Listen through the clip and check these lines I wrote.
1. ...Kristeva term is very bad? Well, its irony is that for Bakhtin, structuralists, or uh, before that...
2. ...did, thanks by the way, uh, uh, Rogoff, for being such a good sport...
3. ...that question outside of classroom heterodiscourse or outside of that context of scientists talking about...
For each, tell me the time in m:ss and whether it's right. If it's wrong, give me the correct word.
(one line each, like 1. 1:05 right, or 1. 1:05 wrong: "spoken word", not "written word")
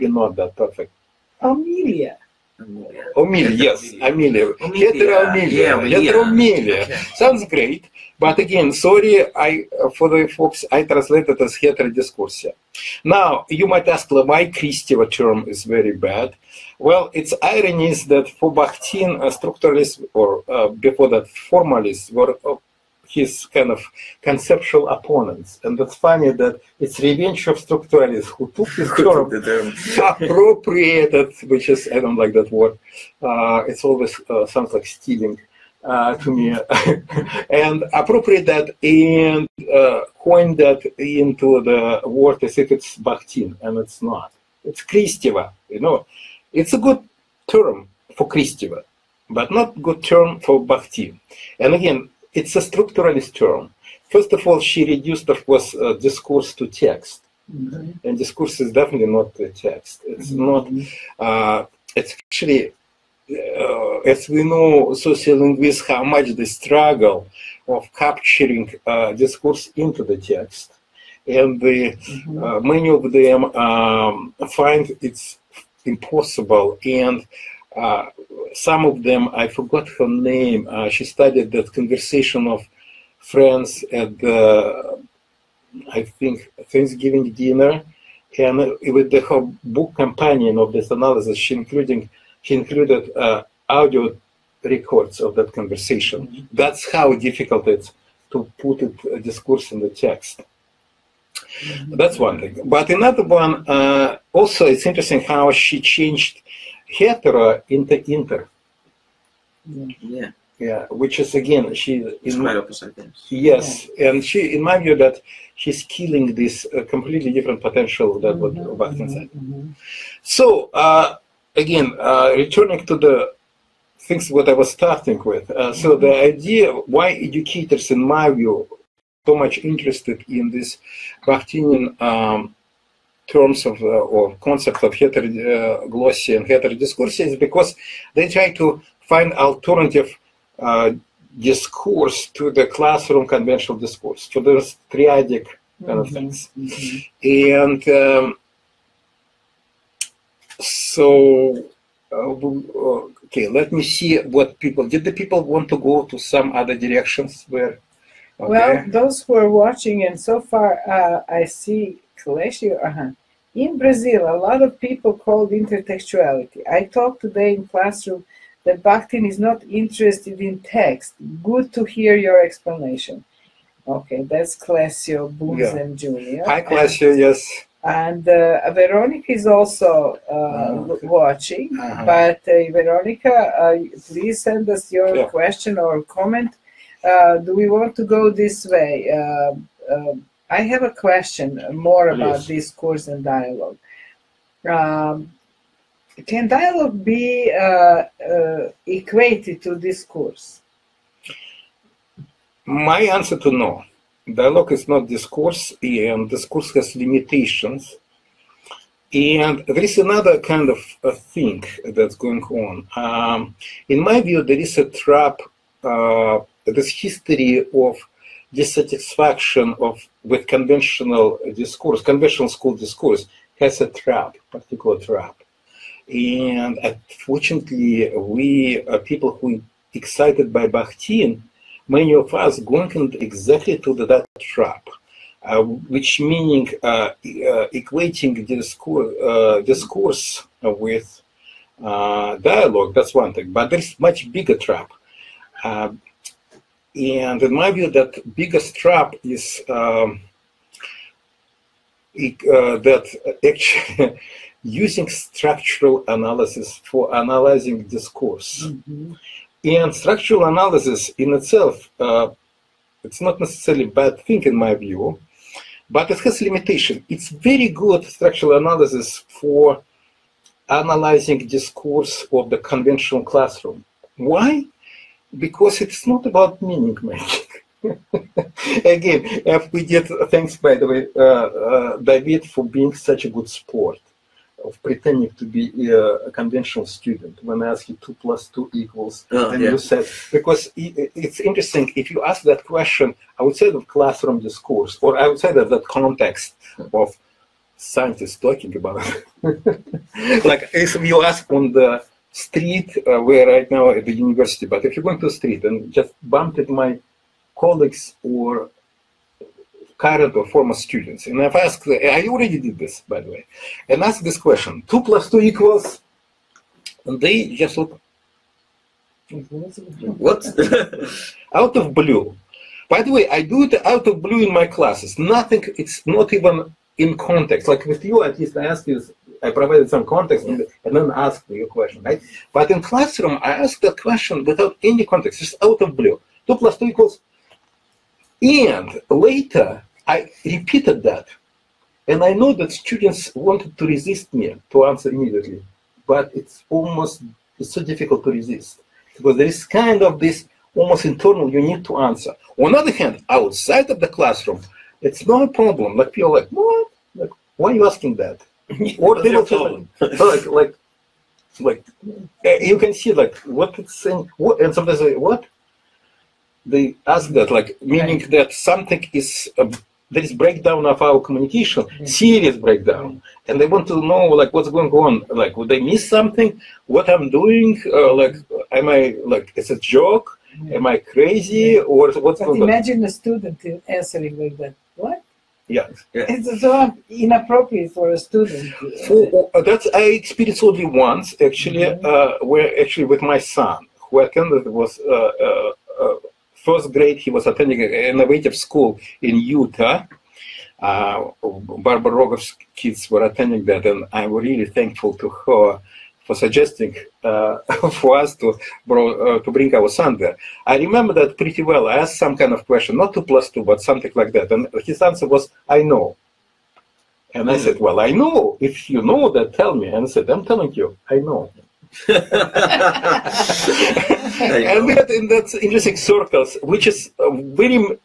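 1. 0:14 right
2. 4:39 wrong: "David", not "Rogoff"
3. 4:52 wrong: "discourse", not "heterodiscourse".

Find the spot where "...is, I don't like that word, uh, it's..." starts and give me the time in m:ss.
0:31.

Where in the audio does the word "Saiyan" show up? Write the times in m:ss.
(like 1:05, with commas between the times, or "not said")
not said.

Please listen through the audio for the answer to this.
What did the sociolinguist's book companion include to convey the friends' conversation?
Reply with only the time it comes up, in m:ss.
1:33.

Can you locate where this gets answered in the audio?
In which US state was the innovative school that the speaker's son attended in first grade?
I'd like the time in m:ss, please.
6:39.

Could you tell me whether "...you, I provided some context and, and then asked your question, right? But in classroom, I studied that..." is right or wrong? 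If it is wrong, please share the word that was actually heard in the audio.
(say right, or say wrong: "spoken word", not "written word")
wrong: "asked", not "studied".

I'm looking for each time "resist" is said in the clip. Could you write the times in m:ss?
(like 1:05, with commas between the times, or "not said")
5:43, 5:48.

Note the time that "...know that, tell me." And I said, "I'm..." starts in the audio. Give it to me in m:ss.
6:59.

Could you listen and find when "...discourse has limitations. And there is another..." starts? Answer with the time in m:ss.
3:26.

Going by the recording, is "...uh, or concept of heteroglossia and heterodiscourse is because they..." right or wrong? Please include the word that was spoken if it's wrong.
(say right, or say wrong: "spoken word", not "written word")
right.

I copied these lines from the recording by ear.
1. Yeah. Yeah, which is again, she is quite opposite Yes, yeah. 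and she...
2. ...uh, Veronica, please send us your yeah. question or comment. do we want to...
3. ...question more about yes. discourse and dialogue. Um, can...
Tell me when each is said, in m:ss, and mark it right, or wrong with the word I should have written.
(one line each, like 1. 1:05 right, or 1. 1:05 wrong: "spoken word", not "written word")
1. 1:50 right
2. 3:02 right
3. 3:11 right.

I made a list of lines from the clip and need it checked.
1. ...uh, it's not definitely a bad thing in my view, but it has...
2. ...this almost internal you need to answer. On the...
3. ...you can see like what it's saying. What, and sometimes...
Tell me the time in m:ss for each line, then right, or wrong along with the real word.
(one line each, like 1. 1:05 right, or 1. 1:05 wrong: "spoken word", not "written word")
1. 4:21 wrong: "necessarily", not "definitely"
2. 5:50 right
3. 6:02 right.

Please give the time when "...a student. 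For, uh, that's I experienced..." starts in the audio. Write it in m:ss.
6:28.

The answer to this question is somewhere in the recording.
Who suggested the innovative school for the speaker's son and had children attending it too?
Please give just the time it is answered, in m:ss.
6:41.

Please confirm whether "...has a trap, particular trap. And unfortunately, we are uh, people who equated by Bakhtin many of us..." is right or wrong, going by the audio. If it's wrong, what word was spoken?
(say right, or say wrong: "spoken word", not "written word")
wrong: "excited", not "equated".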